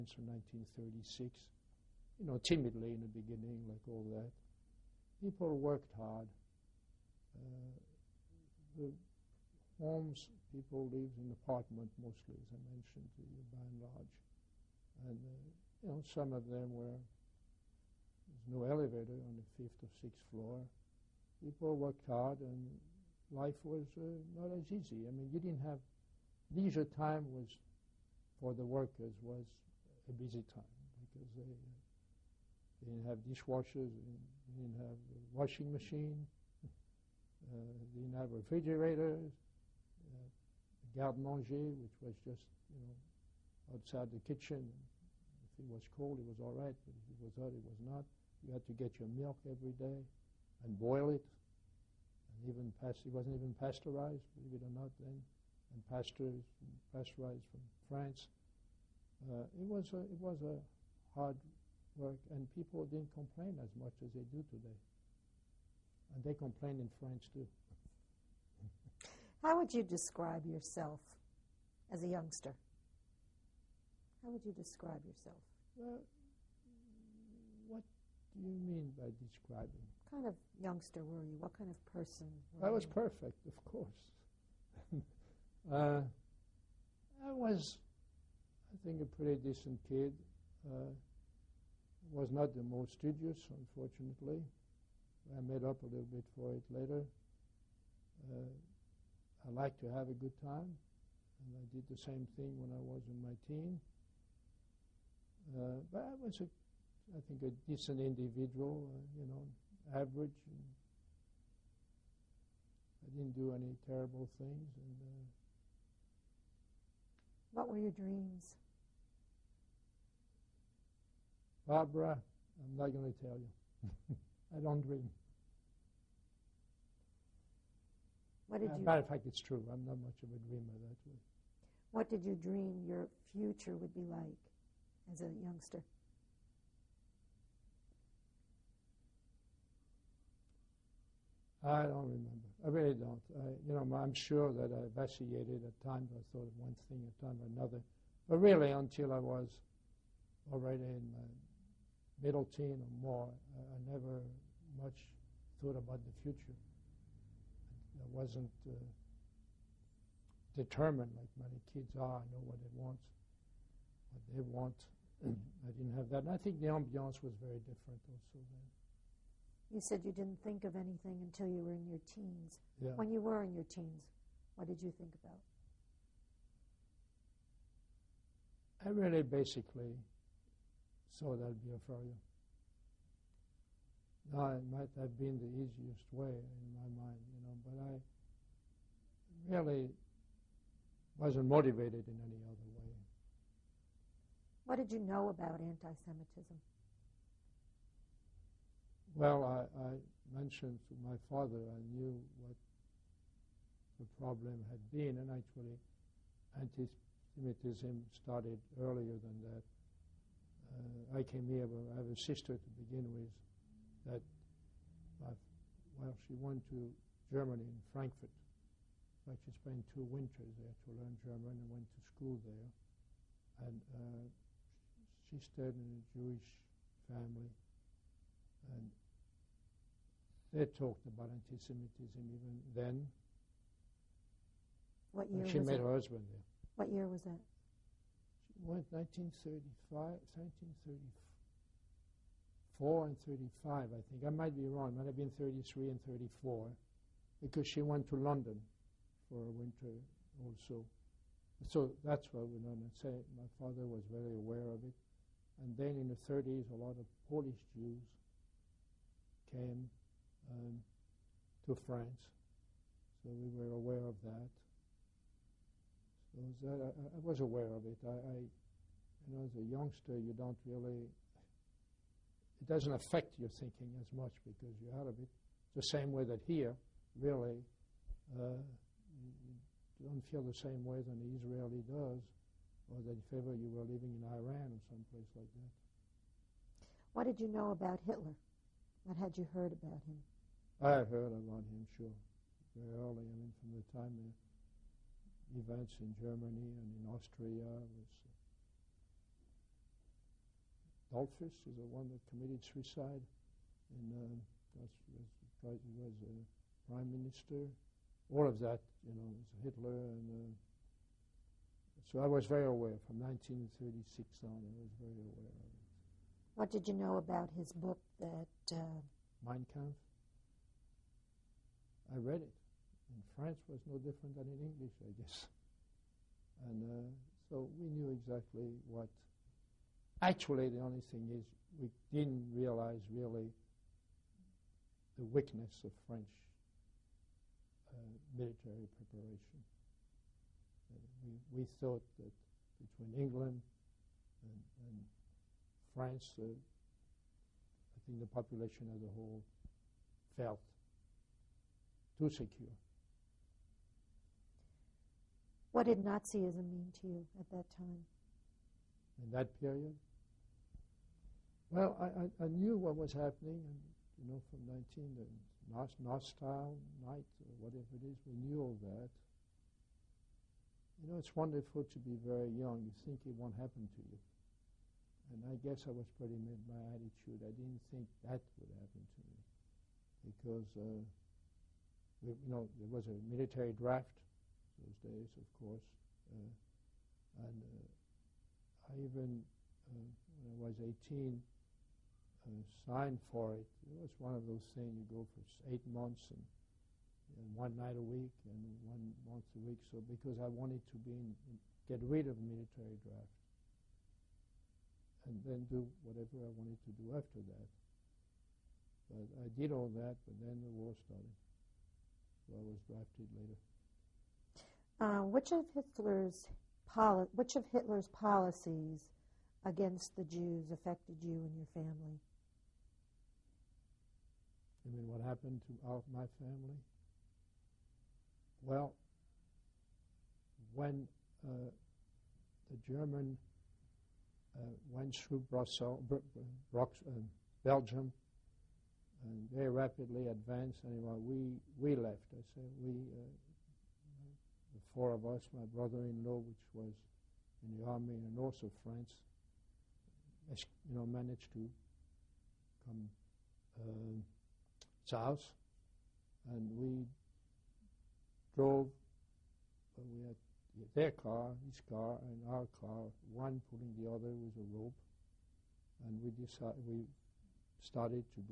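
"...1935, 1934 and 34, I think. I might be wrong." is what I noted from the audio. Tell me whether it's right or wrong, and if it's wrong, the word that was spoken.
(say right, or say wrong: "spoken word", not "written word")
wrong: "35", not "34".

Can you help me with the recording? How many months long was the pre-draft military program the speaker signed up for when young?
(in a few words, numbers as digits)
8.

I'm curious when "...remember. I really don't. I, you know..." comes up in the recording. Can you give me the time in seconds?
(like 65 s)
142 s.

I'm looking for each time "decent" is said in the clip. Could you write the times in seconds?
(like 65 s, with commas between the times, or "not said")
89 s, 107 s.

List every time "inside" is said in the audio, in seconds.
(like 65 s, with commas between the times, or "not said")
not said.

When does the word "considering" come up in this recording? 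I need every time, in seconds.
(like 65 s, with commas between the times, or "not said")
not said.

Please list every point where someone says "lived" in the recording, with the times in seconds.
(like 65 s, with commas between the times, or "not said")
10 s.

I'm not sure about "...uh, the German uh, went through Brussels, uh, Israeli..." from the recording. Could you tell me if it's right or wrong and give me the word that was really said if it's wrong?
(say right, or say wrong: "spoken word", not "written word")
wrong: "Belgium", not "Israeli".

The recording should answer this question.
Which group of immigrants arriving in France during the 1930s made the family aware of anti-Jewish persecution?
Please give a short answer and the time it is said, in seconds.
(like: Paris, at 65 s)
Polish Jews, at 257 s.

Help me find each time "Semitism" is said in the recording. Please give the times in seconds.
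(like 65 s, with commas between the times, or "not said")
196 s, 206 s, 231 s.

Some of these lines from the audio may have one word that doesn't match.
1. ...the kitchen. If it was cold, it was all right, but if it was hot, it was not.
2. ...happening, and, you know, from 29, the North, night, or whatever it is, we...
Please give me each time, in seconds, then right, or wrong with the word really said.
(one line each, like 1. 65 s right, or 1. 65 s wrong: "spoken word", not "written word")
1. 44 s right
2. 363 s wrong: "19", not "29".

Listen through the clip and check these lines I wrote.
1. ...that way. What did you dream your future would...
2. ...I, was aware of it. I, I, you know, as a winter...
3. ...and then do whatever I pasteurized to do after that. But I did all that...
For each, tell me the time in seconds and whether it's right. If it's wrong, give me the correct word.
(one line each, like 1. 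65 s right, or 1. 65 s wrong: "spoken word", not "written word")
1. 130 s right
2. 267 s wrong: "youngster", not "winter"
3. 405 s wrong: "wanted", not "pasteurized".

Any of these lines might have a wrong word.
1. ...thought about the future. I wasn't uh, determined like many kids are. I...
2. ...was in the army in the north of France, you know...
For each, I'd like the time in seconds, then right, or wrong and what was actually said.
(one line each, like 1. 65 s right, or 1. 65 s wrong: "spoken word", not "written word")
1. 155 s right
2. 446 s right.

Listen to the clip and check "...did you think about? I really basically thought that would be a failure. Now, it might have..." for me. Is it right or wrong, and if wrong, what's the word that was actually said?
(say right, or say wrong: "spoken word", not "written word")
right.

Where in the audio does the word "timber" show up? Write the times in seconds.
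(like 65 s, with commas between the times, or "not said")
not said.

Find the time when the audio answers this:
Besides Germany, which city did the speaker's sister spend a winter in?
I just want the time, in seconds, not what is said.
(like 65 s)
248 s.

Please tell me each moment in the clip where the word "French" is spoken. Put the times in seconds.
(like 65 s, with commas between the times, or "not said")
66 s, 323 s, 336 s.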